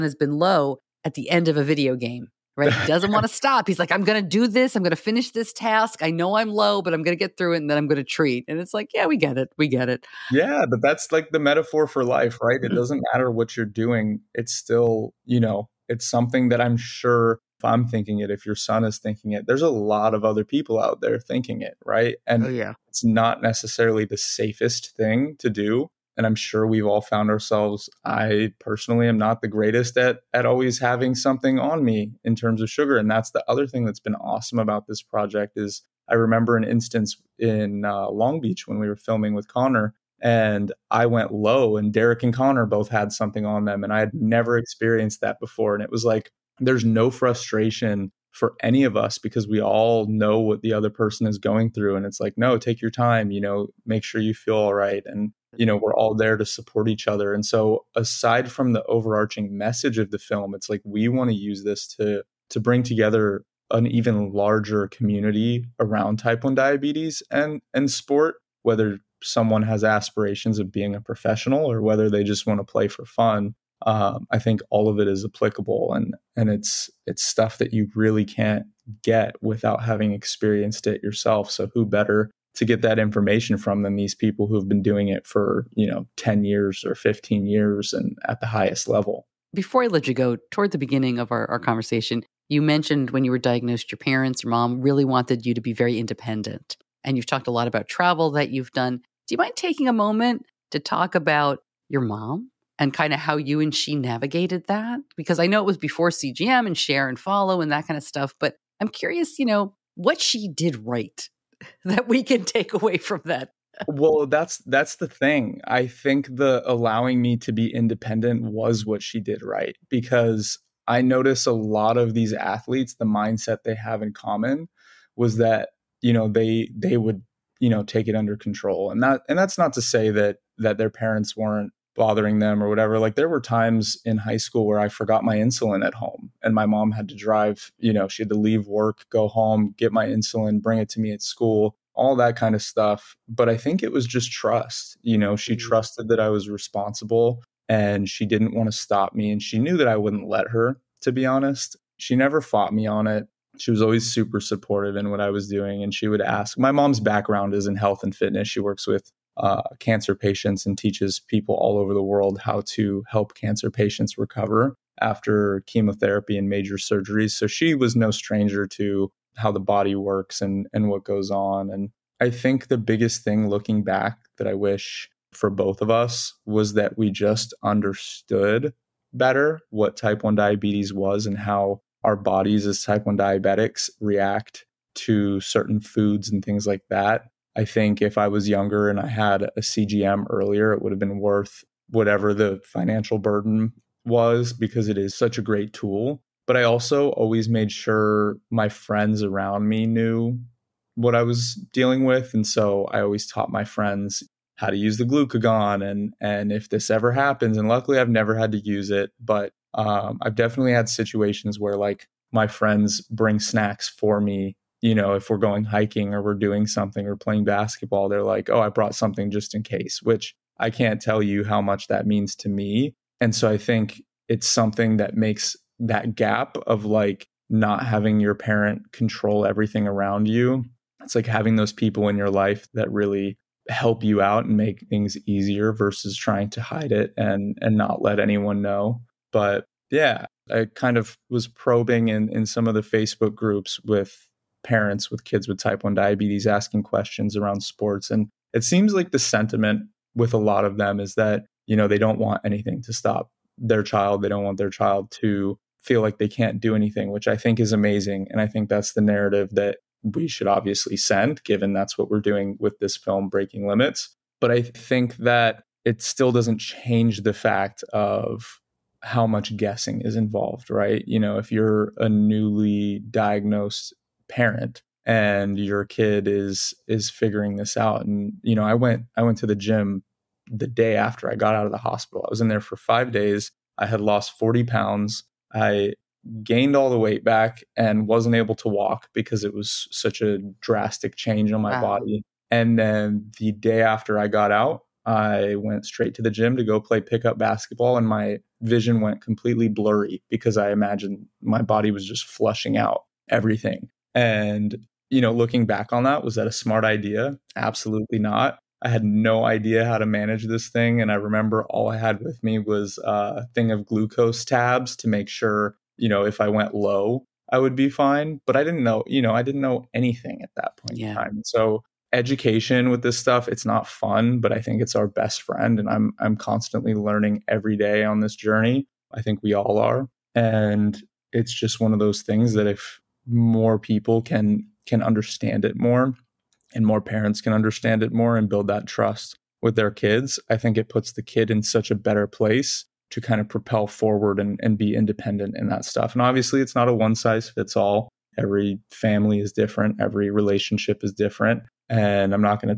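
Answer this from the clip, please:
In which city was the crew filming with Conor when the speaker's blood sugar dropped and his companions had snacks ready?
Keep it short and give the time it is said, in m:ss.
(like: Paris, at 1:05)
Long Beach, at 0:38.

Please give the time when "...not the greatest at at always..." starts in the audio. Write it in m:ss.
0:29.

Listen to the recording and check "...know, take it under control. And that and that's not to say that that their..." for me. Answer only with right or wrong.
right.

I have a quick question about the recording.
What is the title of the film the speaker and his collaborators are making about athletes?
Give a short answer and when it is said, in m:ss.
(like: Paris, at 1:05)
Breaking Limits, at 4:23.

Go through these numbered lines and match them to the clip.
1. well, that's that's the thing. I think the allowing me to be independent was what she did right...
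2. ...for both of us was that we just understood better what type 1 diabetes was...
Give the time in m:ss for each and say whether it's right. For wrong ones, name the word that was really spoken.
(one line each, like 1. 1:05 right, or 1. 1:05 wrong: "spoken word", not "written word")
1. 1:53 right
2. 2:55 right.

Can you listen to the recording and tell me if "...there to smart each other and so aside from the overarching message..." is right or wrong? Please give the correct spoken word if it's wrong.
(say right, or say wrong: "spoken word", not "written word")
wrong: "support", not "smart".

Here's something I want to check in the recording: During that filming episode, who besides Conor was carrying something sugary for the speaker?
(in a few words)
Derek.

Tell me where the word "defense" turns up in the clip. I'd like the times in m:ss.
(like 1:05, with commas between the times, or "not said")
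not said.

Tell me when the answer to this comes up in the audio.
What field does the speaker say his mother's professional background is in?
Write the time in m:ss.
2:37.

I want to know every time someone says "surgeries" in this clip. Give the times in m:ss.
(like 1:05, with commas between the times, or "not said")
2:46.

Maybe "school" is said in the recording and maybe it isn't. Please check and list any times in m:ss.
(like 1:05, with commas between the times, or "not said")
2:14, 2:21.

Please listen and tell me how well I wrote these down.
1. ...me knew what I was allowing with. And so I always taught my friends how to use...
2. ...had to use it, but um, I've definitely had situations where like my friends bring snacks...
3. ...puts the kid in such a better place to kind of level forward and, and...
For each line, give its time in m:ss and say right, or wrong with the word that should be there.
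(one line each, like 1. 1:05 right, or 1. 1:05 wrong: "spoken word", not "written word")
1. 3:19 wrong: "dealing", not "allowing"
2. 3:28 right
3. 5:40 wrong: "propel", not "level".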